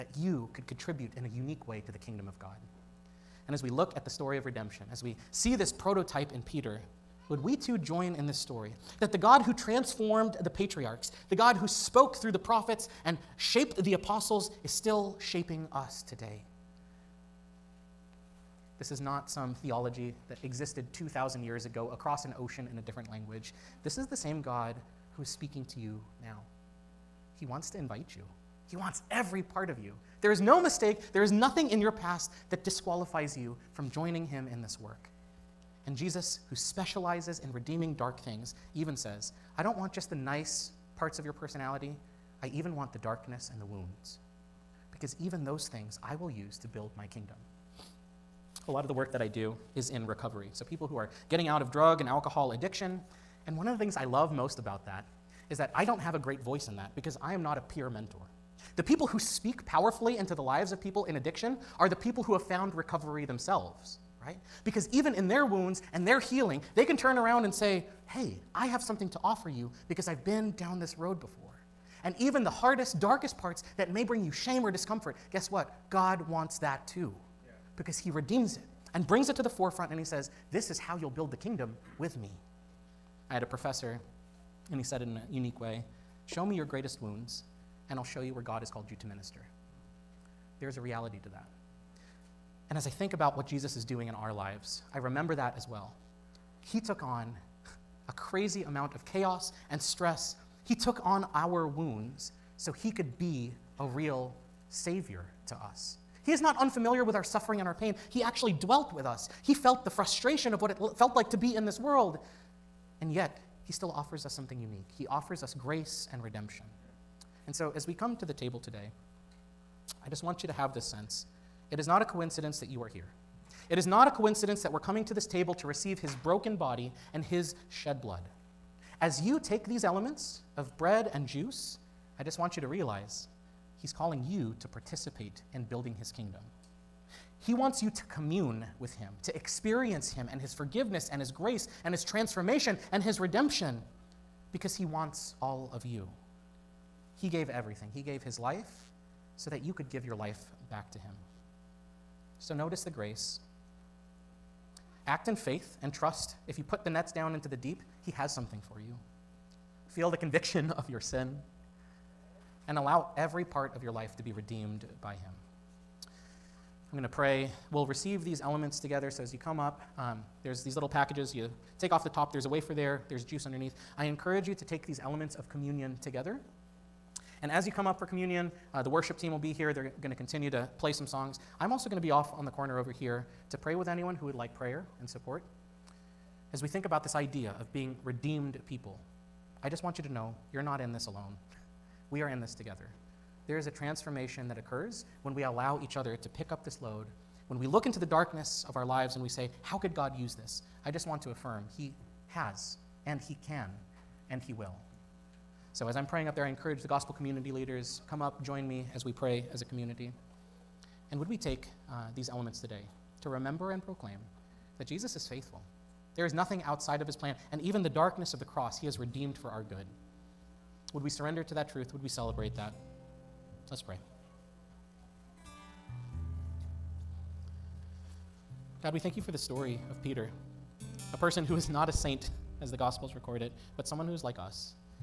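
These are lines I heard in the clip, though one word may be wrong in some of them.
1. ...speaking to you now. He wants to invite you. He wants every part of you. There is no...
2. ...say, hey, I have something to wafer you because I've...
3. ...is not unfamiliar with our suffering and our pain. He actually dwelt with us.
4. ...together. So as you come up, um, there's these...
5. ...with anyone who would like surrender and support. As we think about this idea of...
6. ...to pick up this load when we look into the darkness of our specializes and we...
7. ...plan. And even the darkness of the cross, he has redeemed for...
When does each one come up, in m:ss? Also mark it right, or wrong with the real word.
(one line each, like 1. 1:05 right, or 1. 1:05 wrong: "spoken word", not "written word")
1. 0:25 right
2. 1:07 wrong: "offer", not "wafer"
3. 1:46 right
4. 2:48 right
5. 3:03 wrong: "prayer", not "surrender"
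6. 3:16 wrong: "lives", not "specializes"
7. 3:37 right.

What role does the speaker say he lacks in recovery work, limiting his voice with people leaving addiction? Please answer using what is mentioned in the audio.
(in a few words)
Peer mentor.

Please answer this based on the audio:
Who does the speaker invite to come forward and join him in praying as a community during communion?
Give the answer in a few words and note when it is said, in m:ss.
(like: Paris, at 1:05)
Gospel community leaders, at 3:26.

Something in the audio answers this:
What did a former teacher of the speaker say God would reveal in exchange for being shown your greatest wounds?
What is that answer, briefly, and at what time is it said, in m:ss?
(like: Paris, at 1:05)
Where God has called you to minister, at 1:28.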